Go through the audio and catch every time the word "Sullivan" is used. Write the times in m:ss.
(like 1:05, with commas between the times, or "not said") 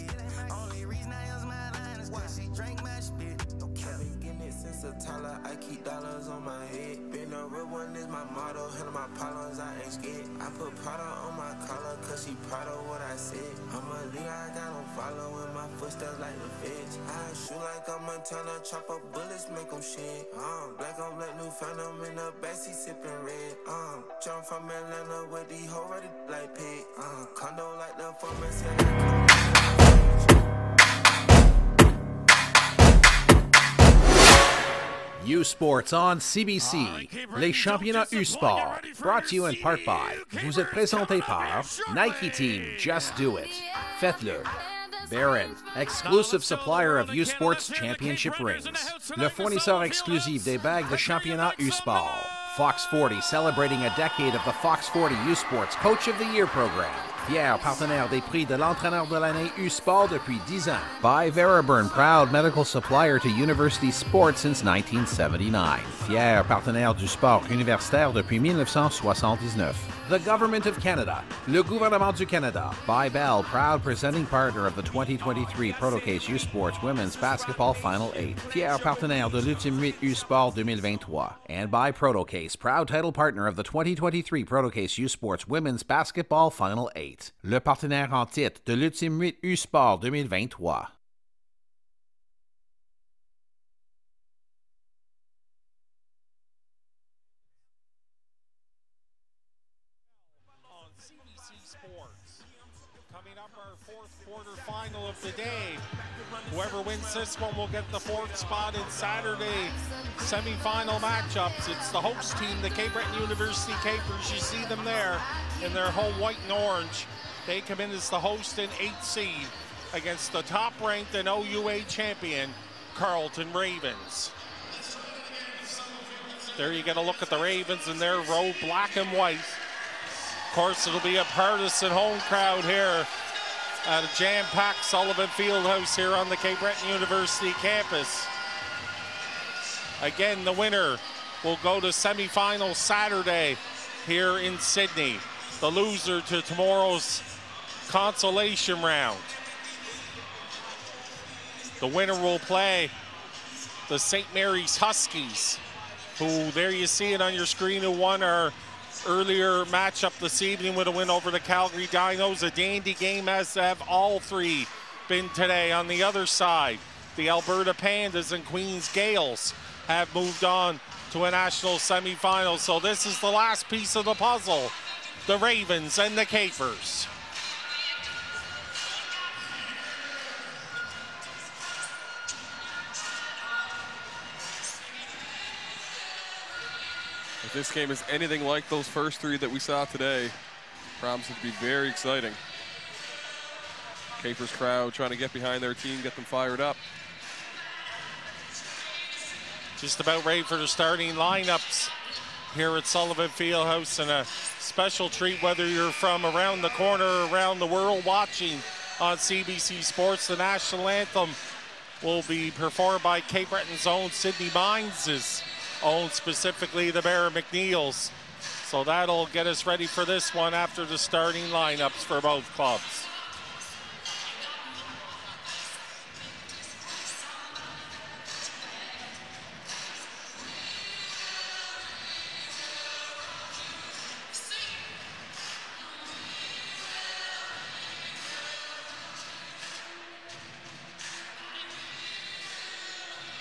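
2:14, 3:22.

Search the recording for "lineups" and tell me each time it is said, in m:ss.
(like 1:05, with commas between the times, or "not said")
3:21, 3:41.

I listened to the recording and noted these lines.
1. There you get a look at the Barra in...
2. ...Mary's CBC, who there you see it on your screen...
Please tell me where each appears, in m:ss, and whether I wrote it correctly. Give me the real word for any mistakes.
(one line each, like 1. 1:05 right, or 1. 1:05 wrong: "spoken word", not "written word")
1. 2:06 wrong: "Ravens", not "Barra"
2. 2:34 wrong: "Huskies", not "CBC".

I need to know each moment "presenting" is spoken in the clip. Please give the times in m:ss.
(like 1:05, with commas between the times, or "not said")
1:13.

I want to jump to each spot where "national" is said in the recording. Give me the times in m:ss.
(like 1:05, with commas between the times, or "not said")
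2:51, 3:30.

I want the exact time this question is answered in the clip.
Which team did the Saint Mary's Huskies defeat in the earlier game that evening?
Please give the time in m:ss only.
2:41.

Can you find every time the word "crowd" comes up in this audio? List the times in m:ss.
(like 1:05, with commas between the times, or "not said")
2:12, 3:14.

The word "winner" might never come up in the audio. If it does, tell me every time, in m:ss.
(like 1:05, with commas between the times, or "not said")
2:20, 2:31.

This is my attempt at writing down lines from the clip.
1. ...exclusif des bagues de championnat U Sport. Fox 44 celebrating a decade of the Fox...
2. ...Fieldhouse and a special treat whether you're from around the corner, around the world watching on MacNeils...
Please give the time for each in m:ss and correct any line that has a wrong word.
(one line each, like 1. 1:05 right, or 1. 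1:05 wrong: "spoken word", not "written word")
1. 0:49 wrong: "40", not "44"
2. 3:23 wrong: "CBC", not "MacNeils".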